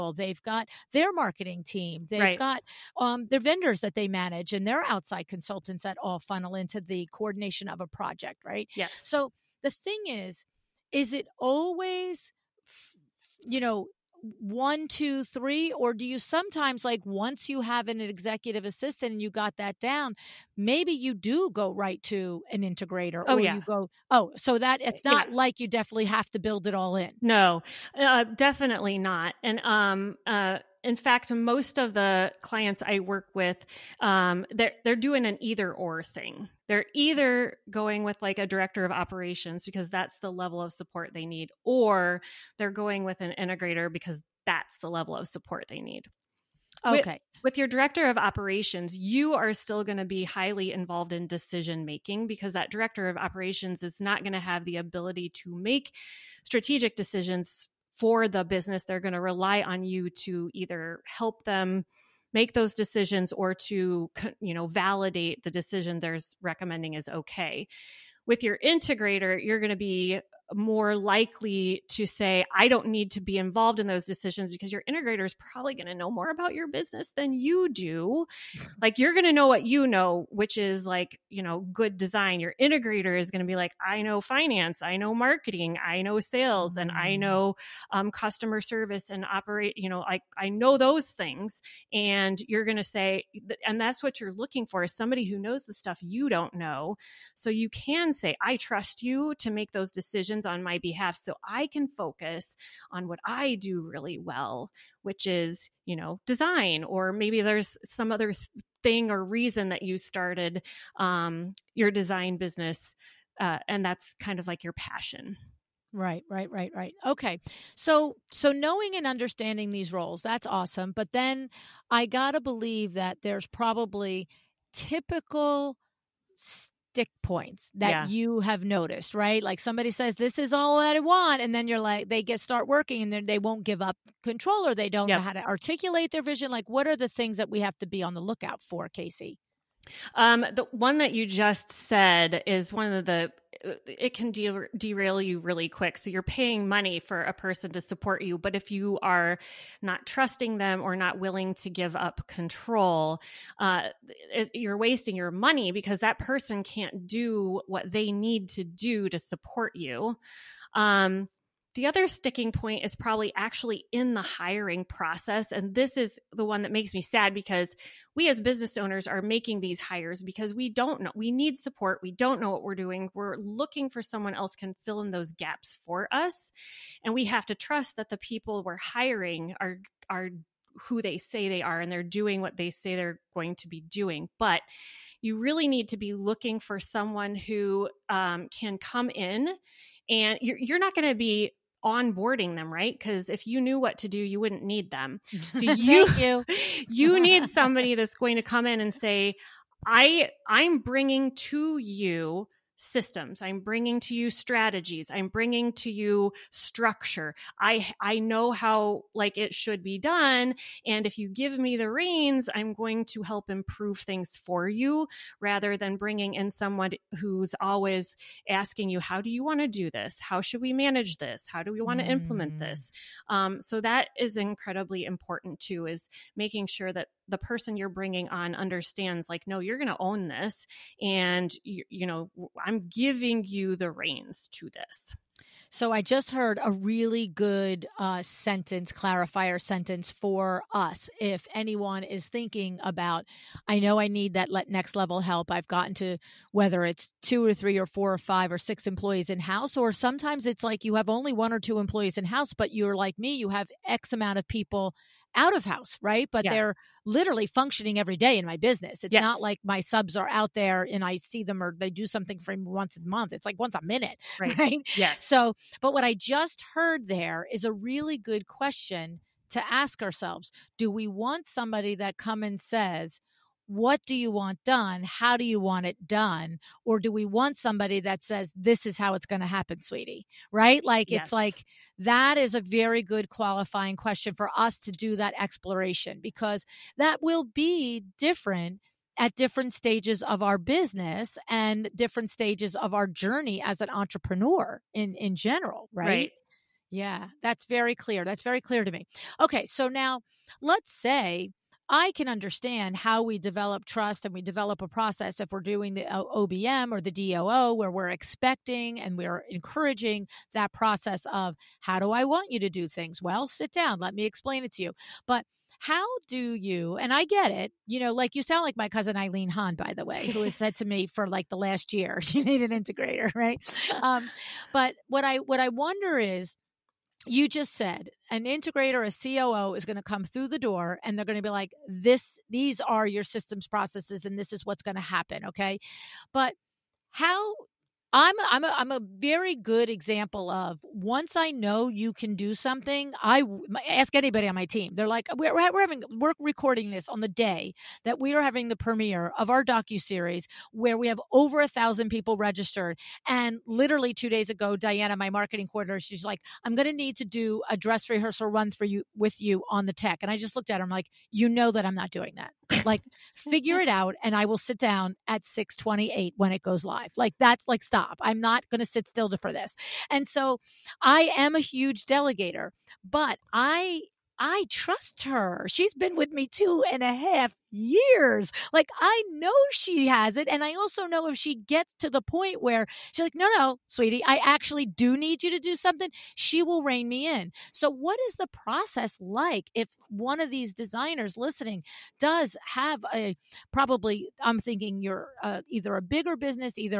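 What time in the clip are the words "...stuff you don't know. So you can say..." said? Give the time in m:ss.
1:35.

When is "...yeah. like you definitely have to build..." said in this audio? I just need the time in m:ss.
0:25.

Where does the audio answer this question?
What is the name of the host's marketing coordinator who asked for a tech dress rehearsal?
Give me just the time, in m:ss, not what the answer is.
5:54.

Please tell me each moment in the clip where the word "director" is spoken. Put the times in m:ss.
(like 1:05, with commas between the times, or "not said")
0:38, 0:47, 0:52.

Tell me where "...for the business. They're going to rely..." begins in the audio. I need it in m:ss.
0:57.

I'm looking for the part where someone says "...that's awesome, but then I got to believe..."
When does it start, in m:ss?
2:00.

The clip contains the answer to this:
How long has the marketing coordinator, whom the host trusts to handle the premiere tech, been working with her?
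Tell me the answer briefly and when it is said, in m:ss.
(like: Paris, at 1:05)
2.5 years, at 6:16.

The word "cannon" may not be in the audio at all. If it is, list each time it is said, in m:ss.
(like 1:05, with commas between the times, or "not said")
not said.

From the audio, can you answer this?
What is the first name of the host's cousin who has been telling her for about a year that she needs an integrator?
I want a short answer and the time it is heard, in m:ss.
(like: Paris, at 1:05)
Eileen, at 5:19.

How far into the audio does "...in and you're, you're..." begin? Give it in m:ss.
3:09.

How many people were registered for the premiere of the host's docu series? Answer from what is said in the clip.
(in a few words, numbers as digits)
Over 1,000.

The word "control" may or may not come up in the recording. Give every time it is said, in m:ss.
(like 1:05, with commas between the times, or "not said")
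2:14, 2:32.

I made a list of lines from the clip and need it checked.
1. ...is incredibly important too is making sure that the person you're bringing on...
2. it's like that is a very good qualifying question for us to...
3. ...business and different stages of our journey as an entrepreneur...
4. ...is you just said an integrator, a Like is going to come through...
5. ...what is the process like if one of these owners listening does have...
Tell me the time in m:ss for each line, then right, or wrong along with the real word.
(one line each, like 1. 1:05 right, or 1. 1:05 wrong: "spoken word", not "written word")
1. 3:44 right
2. 4:41 right
3. 4:50 right
4. 5:26 wrong: "COO", not "Like"
5. 6:27 wrong: "designers", not "owners".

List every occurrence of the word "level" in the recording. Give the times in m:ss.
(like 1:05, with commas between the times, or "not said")
0:40, 0:44, 4:04.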